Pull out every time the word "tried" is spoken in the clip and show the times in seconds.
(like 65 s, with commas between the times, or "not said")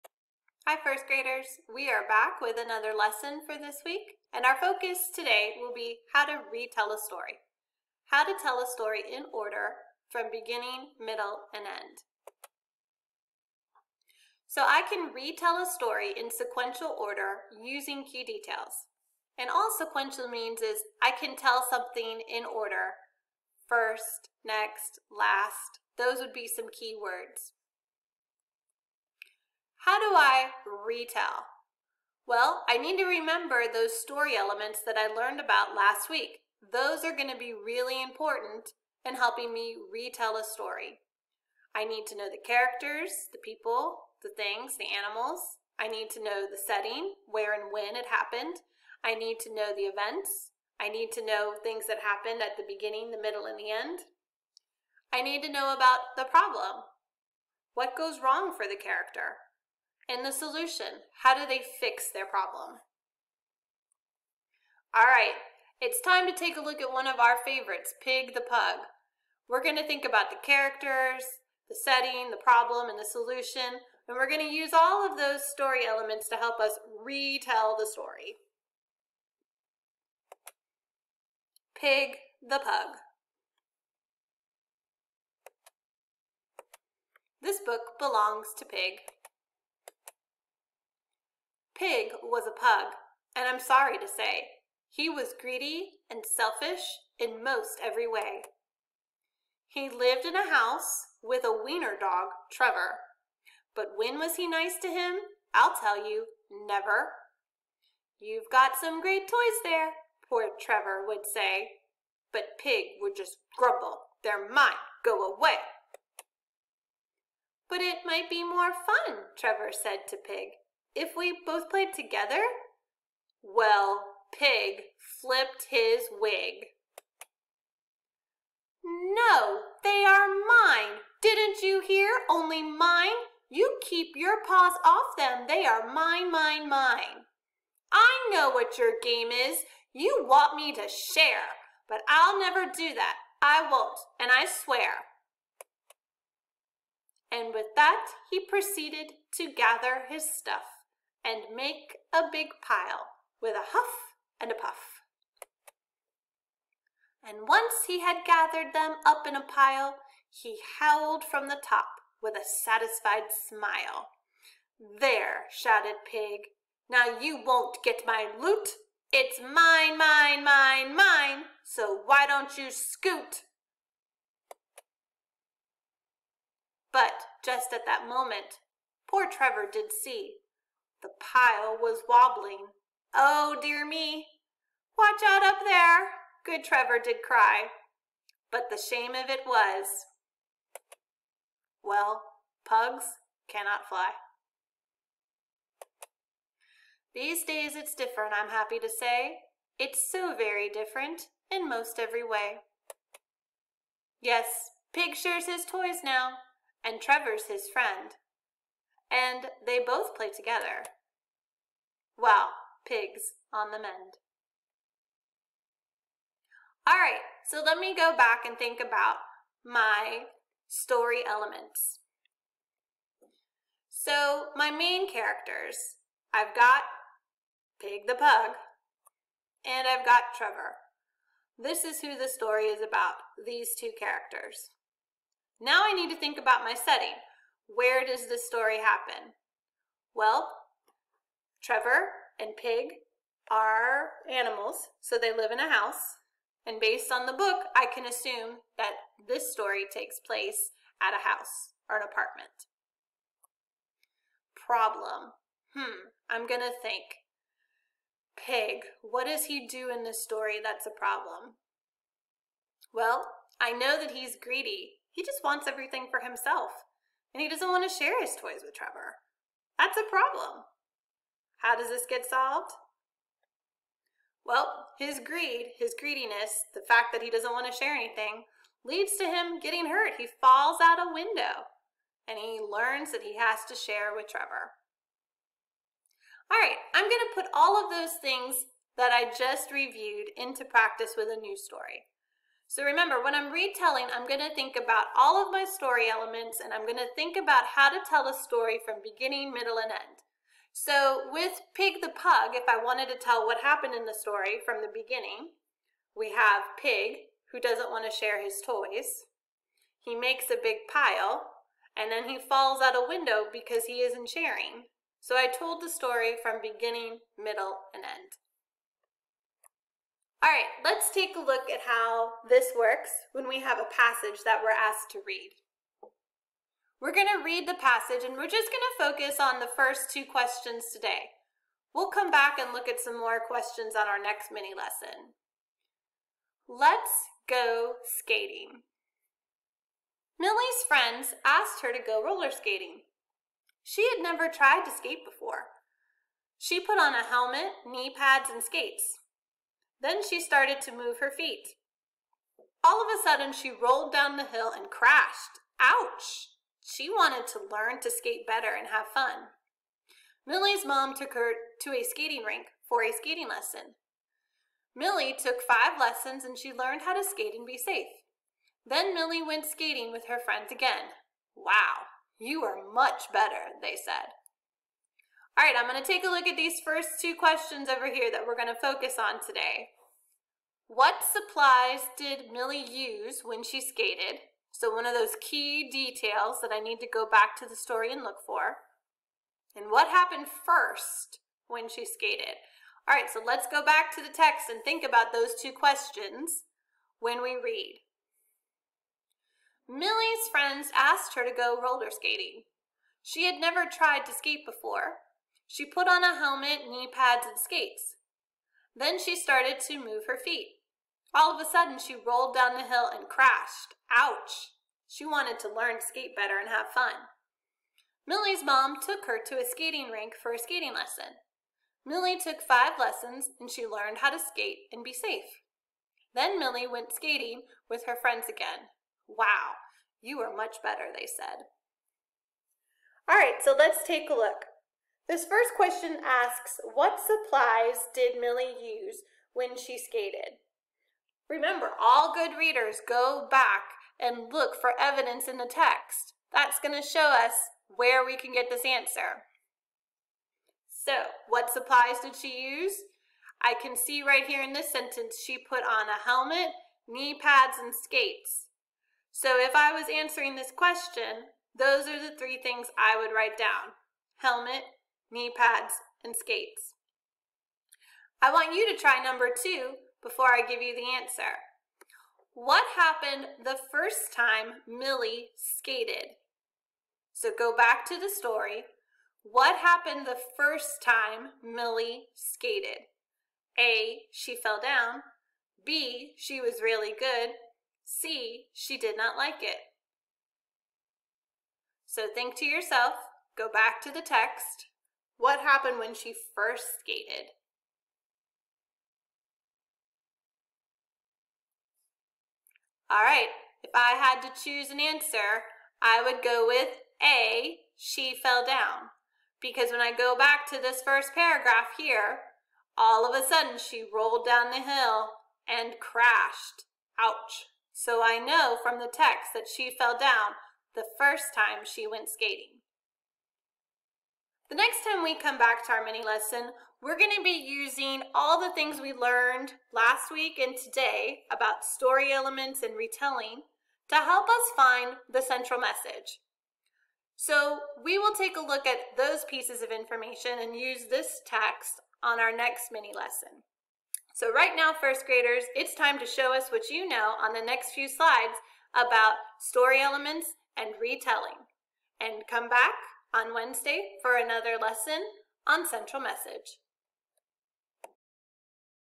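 344 s, 403 s.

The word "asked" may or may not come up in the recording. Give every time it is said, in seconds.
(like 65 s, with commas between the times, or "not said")
324 s, 341 s, 400 s.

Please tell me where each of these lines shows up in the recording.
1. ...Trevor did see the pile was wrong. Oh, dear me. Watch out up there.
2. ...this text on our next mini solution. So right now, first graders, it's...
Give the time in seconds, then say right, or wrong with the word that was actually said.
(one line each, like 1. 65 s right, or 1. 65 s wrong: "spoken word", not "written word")
1. 179 s wrong: "wobbling", not "wrong"
2. 541 s wrong: "lesson", not "solution".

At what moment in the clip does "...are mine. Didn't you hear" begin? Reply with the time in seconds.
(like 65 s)
130 s.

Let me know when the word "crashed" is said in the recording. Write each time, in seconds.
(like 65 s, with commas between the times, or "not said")
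354 s, 413 s, 515 s.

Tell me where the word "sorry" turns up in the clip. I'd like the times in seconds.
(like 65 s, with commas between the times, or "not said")
93 s.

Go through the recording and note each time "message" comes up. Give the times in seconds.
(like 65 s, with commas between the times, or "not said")
535 s, 556 s.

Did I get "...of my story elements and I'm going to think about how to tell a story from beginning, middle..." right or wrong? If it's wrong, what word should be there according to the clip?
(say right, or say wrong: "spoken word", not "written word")
right.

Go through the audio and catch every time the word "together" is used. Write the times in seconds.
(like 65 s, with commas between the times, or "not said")
121 s, 210 s.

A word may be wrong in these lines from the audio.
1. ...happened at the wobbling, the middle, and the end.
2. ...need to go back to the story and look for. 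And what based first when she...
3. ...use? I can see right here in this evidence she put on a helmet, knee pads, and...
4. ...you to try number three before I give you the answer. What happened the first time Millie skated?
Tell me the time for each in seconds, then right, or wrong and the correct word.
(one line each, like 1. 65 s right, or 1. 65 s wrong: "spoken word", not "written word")
1. 52 s wrong: "beginning", not "wobbling"
2. 386 s wrong: "happened", not "based"
3. 452 s wrong: "sentence", not "evidence"
4. 468 s wrong: "two", not "three".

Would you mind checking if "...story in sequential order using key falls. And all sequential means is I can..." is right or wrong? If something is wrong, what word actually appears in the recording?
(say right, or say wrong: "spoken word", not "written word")
wrong: "details", not "falls".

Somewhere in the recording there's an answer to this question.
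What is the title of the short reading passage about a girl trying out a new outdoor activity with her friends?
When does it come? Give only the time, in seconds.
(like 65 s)
336 s.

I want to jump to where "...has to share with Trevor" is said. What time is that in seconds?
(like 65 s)
283 s.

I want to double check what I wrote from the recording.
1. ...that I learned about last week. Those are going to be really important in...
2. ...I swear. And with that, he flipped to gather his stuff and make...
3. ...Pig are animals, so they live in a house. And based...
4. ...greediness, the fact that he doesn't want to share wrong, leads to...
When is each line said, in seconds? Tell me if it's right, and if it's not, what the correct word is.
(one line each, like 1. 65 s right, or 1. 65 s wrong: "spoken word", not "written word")
1. 34 s right
2. 144 s wrong: "proceeded", not "flipped"
3. 242 s right
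4. 275 s wrong: "anything", not "wrong".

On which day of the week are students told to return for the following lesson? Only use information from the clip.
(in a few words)
Wednesday.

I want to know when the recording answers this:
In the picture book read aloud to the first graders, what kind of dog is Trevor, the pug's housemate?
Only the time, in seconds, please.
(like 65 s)
101 s.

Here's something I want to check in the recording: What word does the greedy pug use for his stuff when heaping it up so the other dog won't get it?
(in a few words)
loot.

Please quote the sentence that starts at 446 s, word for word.
That's going to show us where we can get this answer.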